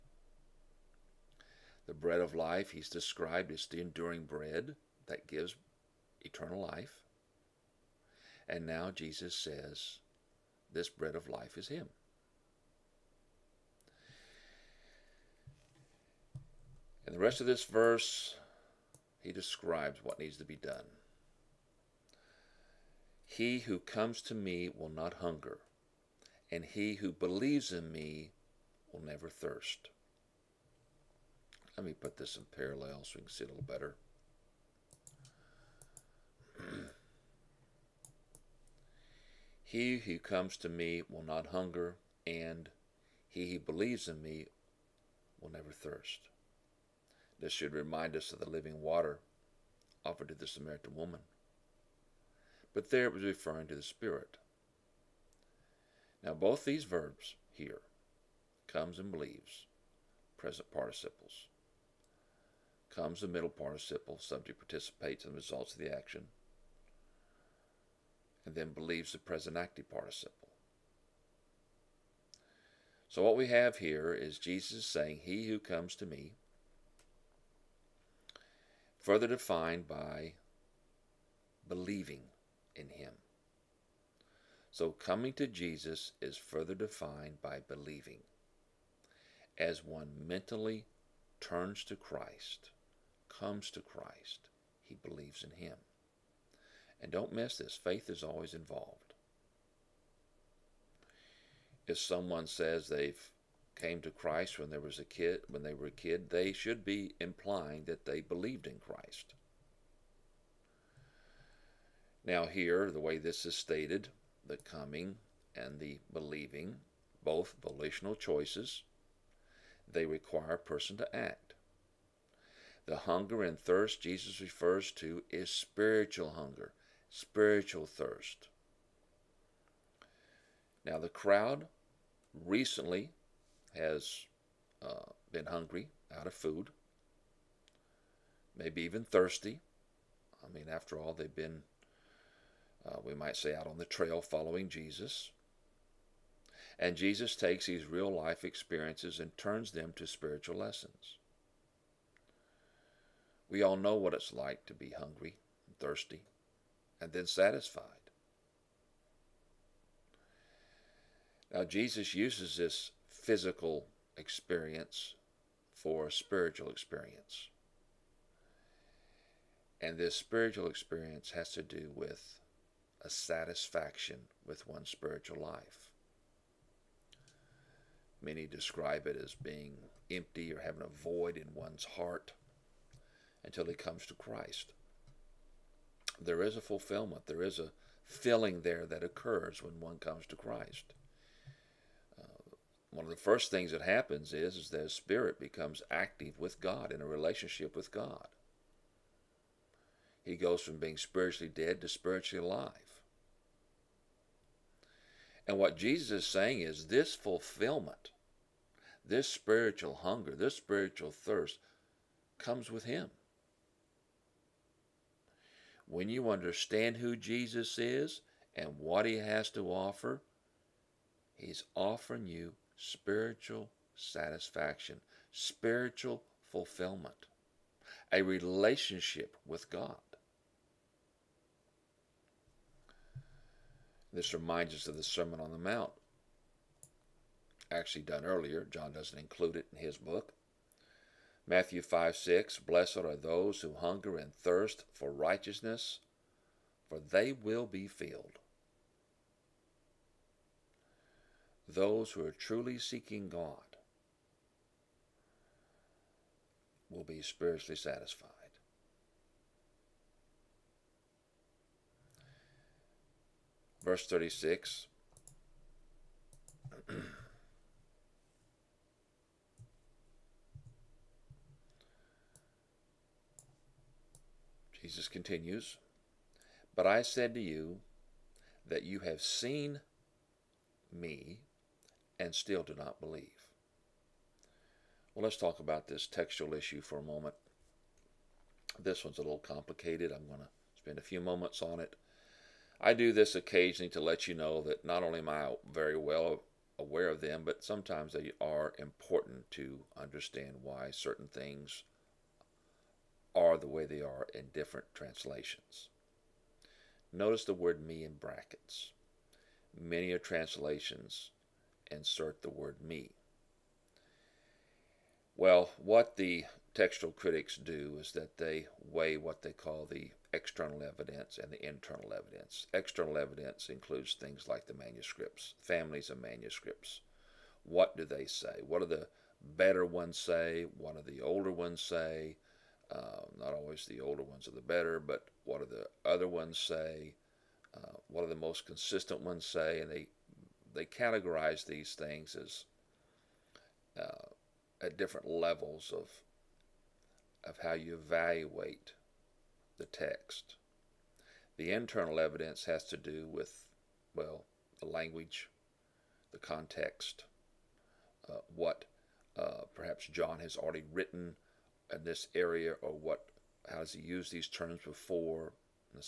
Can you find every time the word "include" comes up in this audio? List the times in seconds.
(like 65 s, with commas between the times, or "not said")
239 s, 323 s.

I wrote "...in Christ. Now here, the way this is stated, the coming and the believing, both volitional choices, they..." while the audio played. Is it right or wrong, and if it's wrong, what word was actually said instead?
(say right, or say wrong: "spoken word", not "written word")
right.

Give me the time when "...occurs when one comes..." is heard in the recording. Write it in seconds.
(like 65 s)
189 s.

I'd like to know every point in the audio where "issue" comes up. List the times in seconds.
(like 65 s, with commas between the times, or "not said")
286 s.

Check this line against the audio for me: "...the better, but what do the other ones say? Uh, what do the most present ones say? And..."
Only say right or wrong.
wrong.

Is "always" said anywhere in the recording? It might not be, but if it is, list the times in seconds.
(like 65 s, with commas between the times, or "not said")
98 s, 333 s.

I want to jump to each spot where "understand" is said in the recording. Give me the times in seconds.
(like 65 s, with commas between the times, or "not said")
216 s, 299 s.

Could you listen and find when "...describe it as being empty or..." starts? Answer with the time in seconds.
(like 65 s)
178 s.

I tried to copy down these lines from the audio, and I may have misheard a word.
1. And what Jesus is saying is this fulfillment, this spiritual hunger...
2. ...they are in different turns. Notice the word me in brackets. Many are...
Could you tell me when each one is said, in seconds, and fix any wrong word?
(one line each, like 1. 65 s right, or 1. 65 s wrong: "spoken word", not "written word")
1. 205 s right
2. 303 s wrong: "translations", not "turns".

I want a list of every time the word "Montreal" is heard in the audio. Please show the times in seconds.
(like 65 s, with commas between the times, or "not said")
not said.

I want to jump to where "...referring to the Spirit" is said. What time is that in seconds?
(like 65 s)
53 s.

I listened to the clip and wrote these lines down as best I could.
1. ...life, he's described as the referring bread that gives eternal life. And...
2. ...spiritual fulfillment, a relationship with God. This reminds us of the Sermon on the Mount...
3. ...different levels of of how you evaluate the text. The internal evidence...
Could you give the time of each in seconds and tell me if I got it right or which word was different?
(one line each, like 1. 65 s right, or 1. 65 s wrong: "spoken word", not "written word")
1. 2 s wrong: "enduring", not "referring"
2. 225 s right
3. 344 s right.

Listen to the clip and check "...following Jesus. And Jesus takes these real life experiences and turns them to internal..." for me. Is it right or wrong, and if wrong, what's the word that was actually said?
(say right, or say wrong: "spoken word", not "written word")
wrong: "spiritual", not "internal".